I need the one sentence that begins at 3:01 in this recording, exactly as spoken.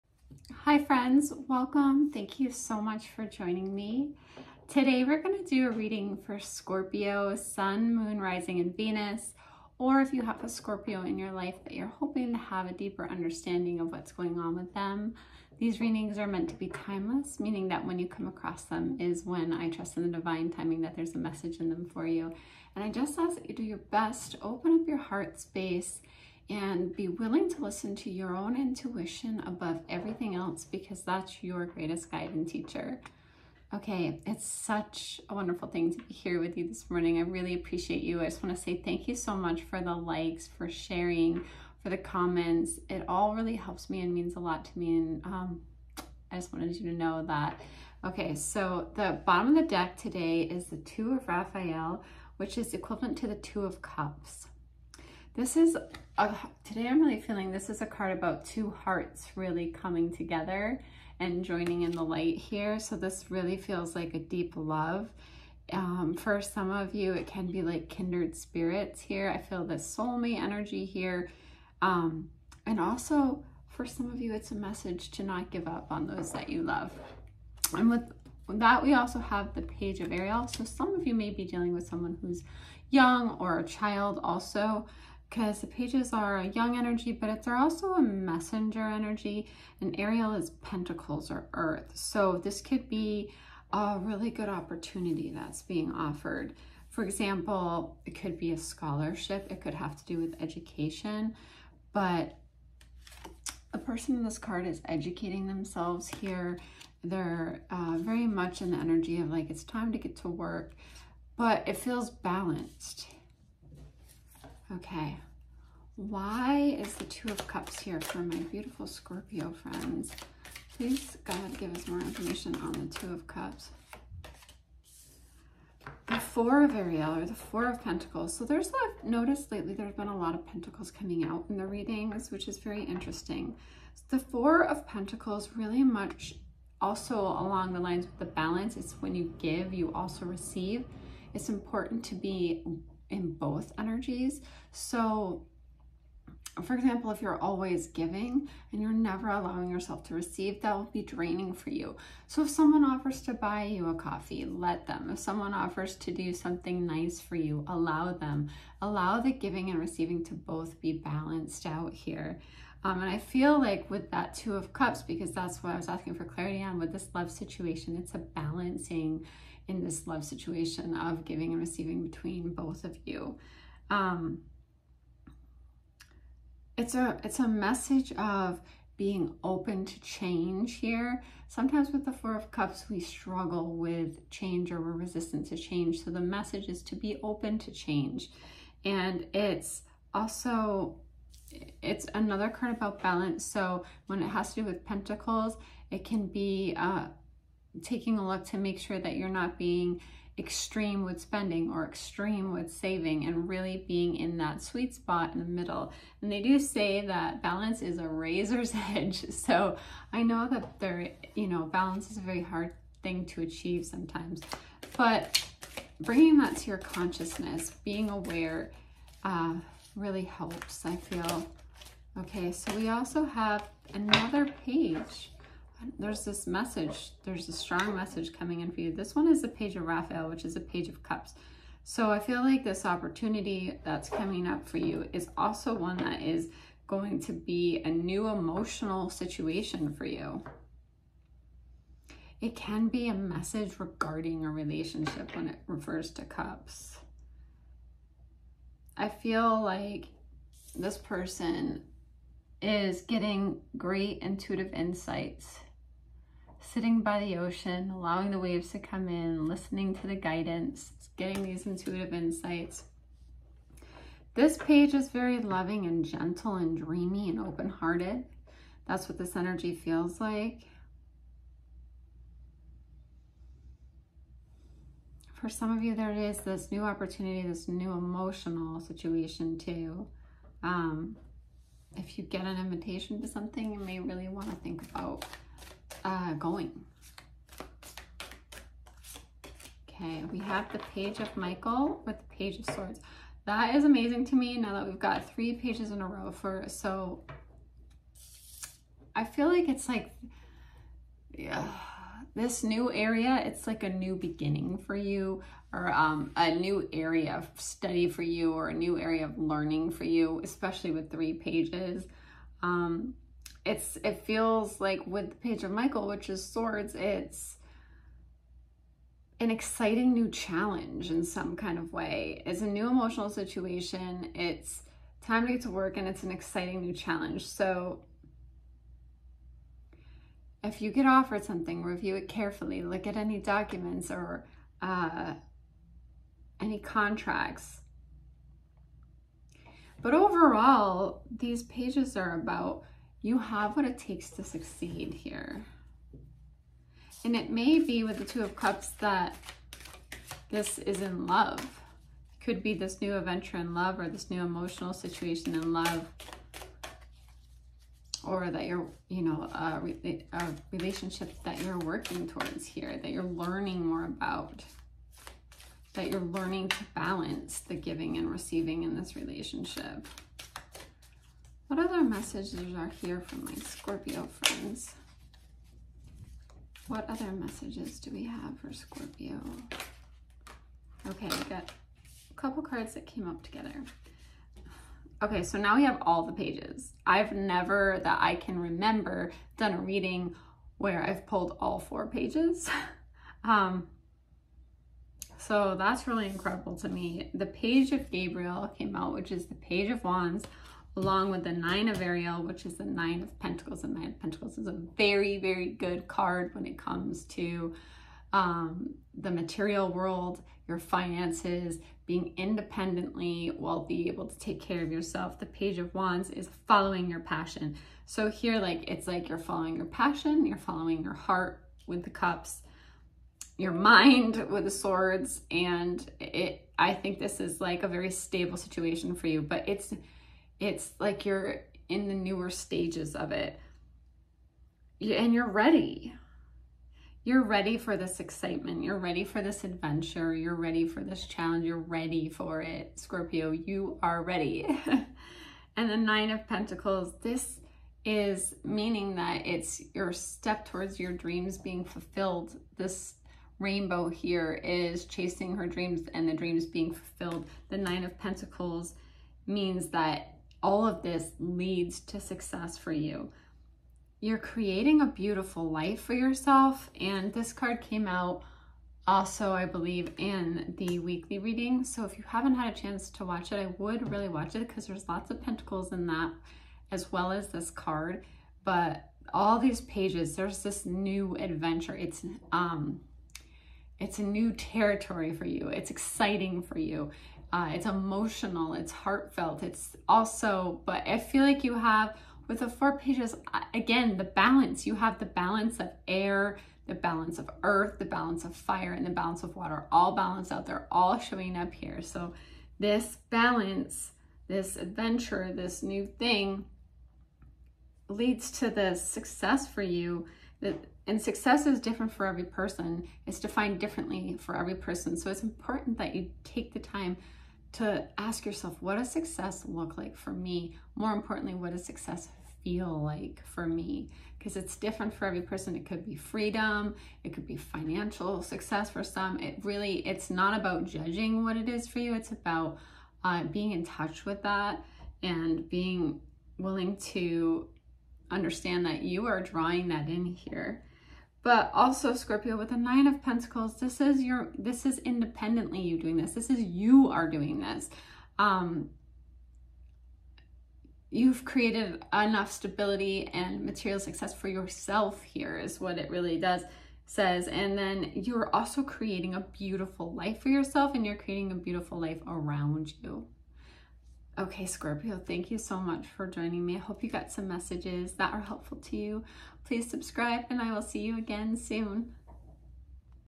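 Sometimes with the Four of Cups, we struggle with change or we're resistant to change.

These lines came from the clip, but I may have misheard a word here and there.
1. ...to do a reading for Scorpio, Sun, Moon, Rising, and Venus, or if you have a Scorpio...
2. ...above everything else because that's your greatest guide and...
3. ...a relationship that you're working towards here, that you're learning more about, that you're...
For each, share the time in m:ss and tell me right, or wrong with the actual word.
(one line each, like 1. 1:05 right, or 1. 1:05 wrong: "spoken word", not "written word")
1. 0:05 right
2. 0:29 right
3. 5:59 right.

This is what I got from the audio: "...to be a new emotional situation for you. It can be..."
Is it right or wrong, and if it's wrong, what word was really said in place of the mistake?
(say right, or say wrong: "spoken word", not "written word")
right.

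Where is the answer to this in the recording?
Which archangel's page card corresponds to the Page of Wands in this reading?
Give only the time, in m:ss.
6:38.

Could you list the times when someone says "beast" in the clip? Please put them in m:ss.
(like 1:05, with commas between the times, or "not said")
not said.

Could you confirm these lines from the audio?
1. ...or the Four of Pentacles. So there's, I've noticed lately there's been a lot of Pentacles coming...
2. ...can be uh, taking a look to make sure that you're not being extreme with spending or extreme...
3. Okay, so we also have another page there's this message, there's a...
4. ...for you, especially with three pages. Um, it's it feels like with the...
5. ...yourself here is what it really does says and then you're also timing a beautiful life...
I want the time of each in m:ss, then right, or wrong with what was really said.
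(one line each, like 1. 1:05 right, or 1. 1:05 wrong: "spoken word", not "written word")
1. 2:07 right
2. 3:16 right
3. 3:42 right
4. 5:09 right
5. 9:14 wrong: "creating", not "timing".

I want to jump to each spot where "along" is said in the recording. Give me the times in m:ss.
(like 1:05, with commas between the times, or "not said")
2:17, 6:40.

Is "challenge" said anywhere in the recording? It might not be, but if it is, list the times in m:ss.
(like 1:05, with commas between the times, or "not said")
5:20, 5:26, 7:21.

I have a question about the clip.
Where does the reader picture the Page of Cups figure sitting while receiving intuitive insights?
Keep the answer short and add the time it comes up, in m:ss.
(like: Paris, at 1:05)
By the ocean, at 4:17.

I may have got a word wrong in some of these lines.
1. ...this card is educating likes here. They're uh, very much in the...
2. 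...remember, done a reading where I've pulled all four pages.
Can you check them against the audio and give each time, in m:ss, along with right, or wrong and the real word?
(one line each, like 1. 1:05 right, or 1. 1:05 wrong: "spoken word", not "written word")
1. 1:44 wrong: "themselves", not "likes"
2. 6:28 right.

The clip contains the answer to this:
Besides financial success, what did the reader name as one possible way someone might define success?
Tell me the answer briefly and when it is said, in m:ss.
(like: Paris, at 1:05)
Freedom, at 8:46.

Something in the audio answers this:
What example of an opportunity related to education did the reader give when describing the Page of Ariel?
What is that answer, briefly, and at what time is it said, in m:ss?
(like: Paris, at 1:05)
A scholarship, at 1:38.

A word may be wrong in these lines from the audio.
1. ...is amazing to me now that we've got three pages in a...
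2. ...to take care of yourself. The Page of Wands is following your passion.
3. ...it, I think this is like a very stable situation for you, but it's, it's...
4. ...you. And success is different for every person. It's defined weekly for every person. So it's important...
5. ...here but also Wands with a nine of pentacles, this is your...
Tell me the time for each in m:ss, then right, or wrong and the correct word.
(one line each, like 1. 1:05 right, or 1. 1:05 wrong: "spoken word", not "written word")
1. 4:53 right
2. 6:54 right
3. 7:06 right
4. 8:29 wrong: "differently", not "weekly"
5. 9:00 wrong: "Scorpio", not "Wands".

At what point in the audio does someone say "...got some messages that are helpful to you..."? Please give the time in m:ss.
9:27.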